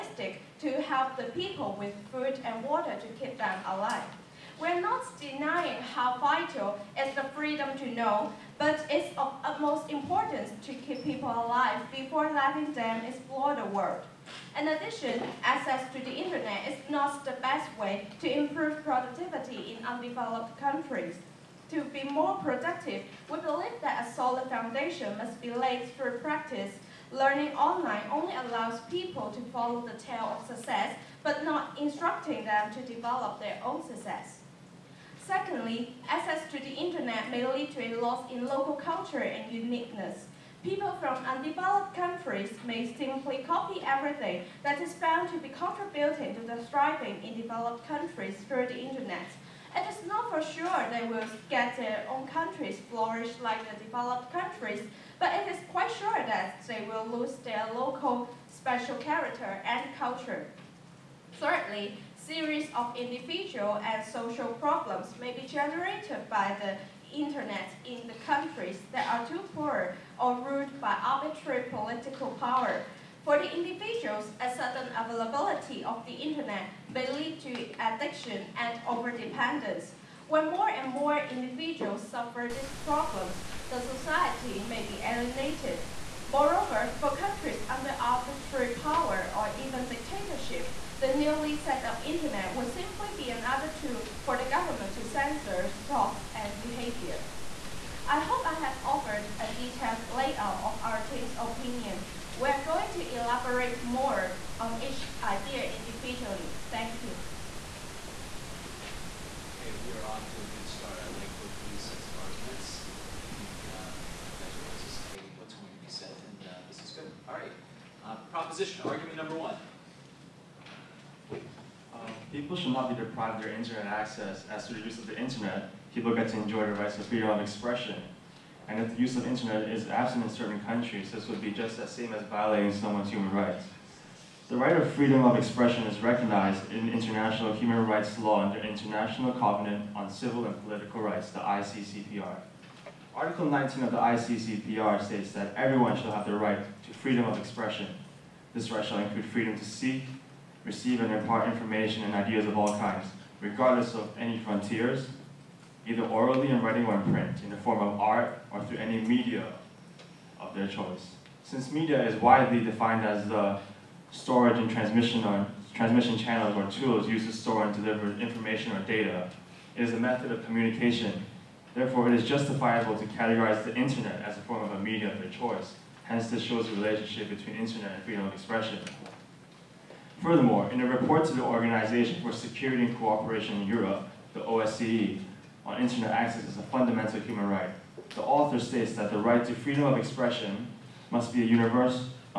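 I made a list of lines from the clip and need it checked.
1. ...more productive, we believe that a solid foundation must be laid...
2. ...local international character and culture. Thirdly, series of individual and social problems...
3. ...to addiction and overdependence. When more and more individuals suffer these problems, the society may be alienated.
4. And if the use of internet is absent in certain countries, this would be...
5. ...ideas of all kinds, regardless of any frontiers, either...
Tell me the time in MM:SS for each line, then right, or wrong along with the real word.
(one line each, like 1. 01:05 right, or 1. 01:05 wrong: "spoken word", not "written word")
1. 00:22 right
2. 00:57 wrong: "special", not "international"
3. 01:17 right
4. 02:08 right
5. 02:32 right.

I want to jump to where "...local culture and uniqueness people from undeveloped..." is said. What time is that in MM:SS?
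00:38.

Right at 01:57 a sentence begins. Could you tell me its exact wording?
All right, uh, proposition, argument number one.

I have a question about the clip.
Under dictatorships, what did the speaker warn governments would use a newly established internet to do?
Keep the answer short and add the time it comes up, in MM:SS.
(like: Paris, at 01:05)
Censor thoughts and behavior, at 01:35.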